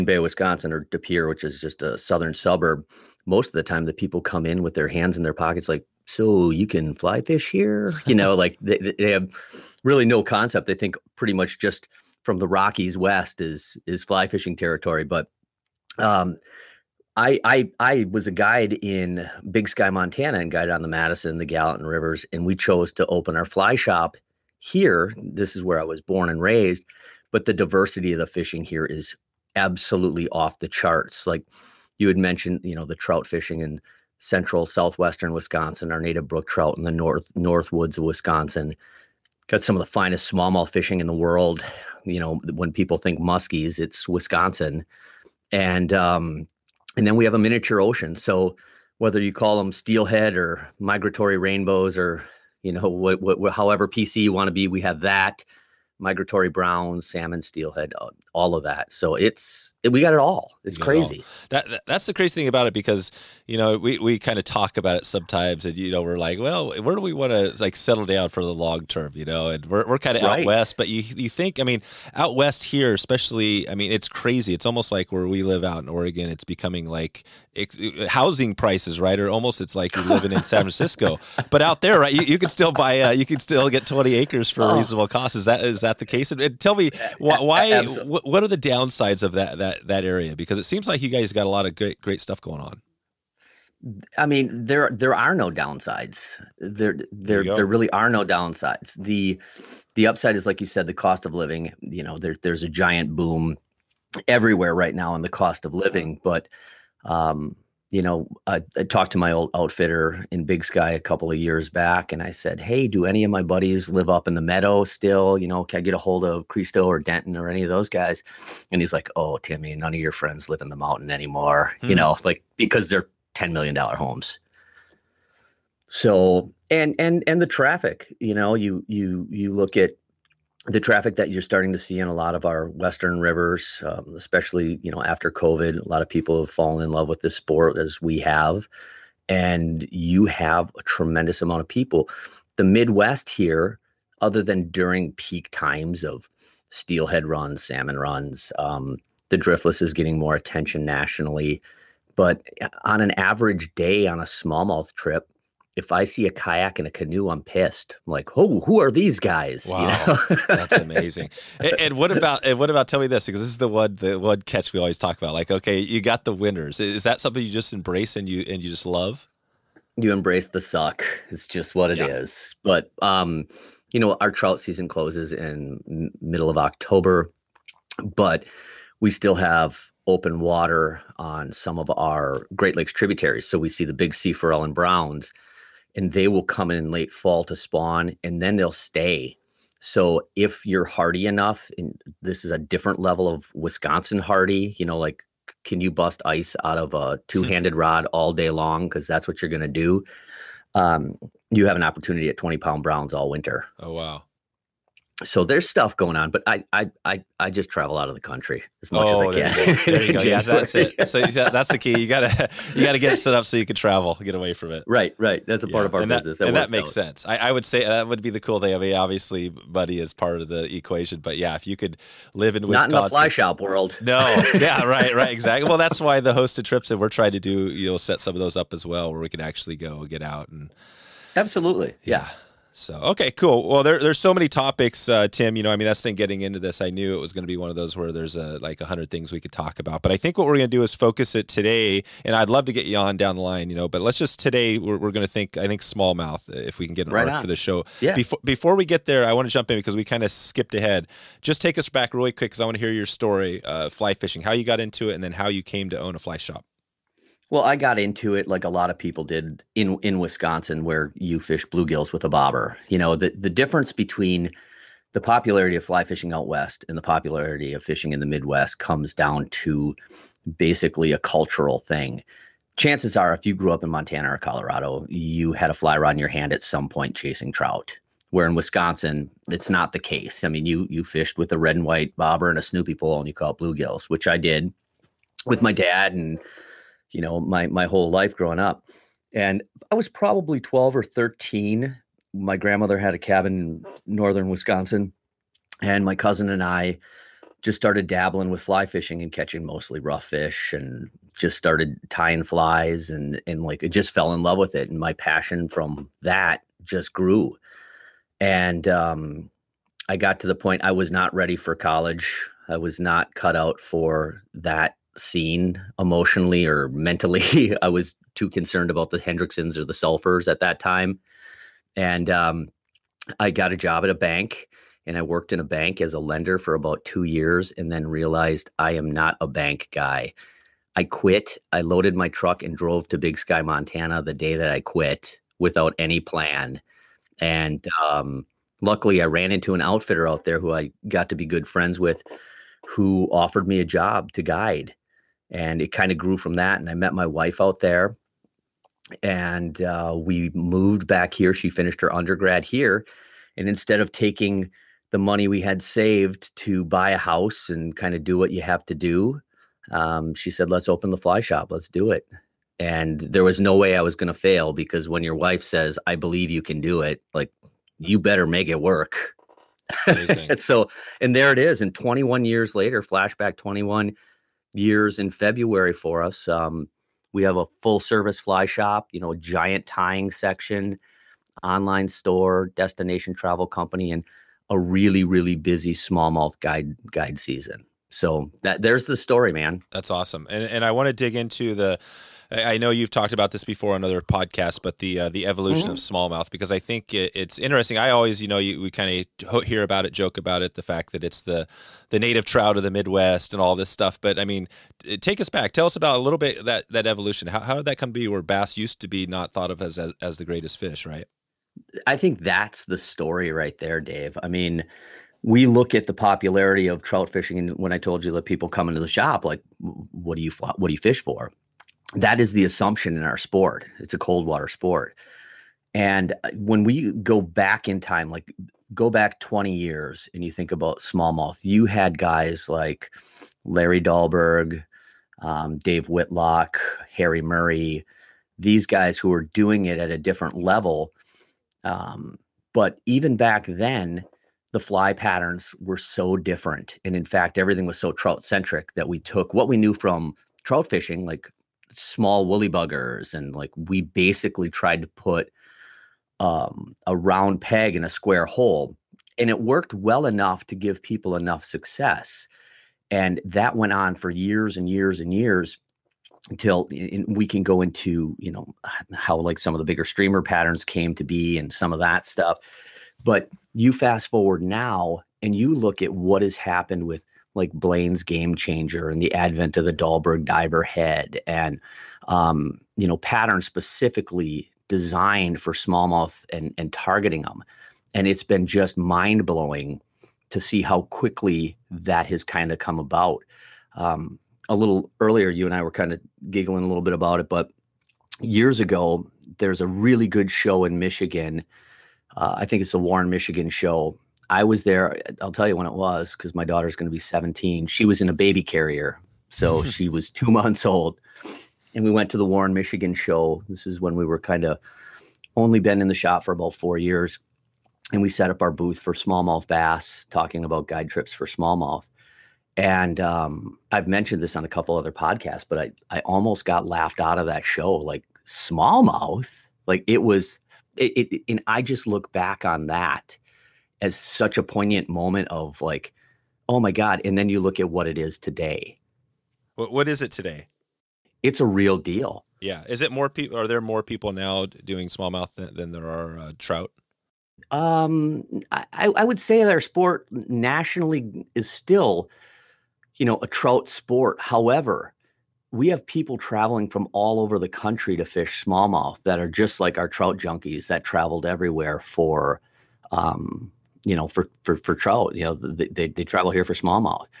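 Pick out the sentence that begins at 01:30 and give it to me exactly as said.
Because it seems like you guys got a lot of great great stuff going on.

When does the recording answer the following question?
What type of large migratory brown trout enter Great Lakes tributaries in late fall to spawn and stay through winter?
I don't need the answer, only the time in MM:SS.
03:04.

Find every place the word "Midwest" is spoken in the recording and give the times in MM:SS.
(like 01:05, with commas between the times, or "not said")
02:22, 04:28, 06:42.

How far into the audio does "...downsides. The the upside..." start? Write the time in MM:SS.
01:38.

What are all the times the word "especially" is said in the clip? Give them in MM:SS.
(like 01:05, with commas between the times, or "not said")
01:12, 02:14.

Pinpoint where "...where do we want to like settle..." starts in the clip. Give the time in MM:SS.
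01:06.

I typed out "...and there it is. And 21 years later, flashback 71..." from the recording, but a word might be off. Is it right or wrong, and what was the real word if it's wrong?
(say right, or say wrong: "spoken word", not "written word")
wrong: "21", not "71".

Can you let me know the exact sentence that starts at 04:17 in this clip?
Well, I got into it like a lot of people did in in Wisconsin, where you fish bluegills with a bobber.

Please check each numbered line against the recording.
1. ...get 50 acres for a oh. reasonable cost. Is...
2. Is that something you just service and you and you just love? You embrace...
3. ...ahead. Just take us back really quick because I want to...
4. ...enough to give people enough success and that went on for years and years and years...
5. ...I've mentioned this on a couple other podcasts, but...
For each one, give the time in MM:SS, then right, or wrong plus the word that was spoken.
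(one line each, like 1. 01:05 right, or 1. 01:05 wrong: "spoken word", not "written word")
1. 01:23 wrong: "20", not "50"
2. 02:46 wrong: "embrace", not "service"
3. 04:10 right
4. 07:40 right
5. 08:43 right.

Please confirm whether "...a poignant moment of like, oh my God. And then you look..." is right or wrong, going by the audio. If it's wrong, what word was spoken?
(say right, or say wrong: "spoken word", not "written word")
right.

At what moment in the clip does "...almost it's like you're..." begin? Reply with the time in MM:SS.
01:19.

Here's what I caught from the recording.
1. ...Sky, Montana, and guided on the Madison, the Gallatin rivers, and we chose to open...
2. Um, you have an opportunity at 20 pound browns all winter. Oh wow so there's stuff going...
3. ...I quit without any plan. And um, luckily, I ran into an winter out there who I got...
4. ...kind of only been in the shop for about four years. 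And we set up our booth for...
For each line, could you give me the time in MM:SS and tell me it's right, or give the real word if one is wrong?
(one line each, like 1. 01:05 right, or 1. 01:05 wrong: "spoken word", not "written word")
1. 00:19 right
2. 03:20 right
3. 05:34 wrong: "outfitter", not "winter"
4. 08:34 right.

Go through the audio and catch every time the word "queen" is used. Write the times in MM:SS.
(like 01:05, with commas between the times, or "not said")
not said.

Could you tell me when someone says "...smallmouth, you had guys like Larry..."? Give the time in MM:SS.
07:10.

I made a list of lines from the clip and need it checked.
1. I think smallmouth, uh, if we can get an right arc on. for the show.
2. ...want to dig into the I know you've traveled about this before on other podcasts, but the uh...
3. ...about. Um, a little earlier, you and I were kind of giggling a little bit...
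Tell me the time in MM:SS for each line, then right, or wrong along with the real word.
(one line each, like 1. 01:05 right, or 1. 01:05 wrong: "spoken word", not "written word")
1. 04:05 right
2. 06:30 wrong: "talked", not "traveled"
3. 08:12 right.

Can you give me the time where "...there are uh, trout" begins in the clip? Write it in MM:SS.
09:05.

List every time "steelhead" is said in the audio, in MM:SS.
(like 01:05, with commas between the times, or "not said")
00:49, 00:57, 02:26.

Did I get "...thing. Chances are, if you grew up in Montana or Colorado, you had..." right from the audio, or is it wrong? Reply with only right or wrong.
right.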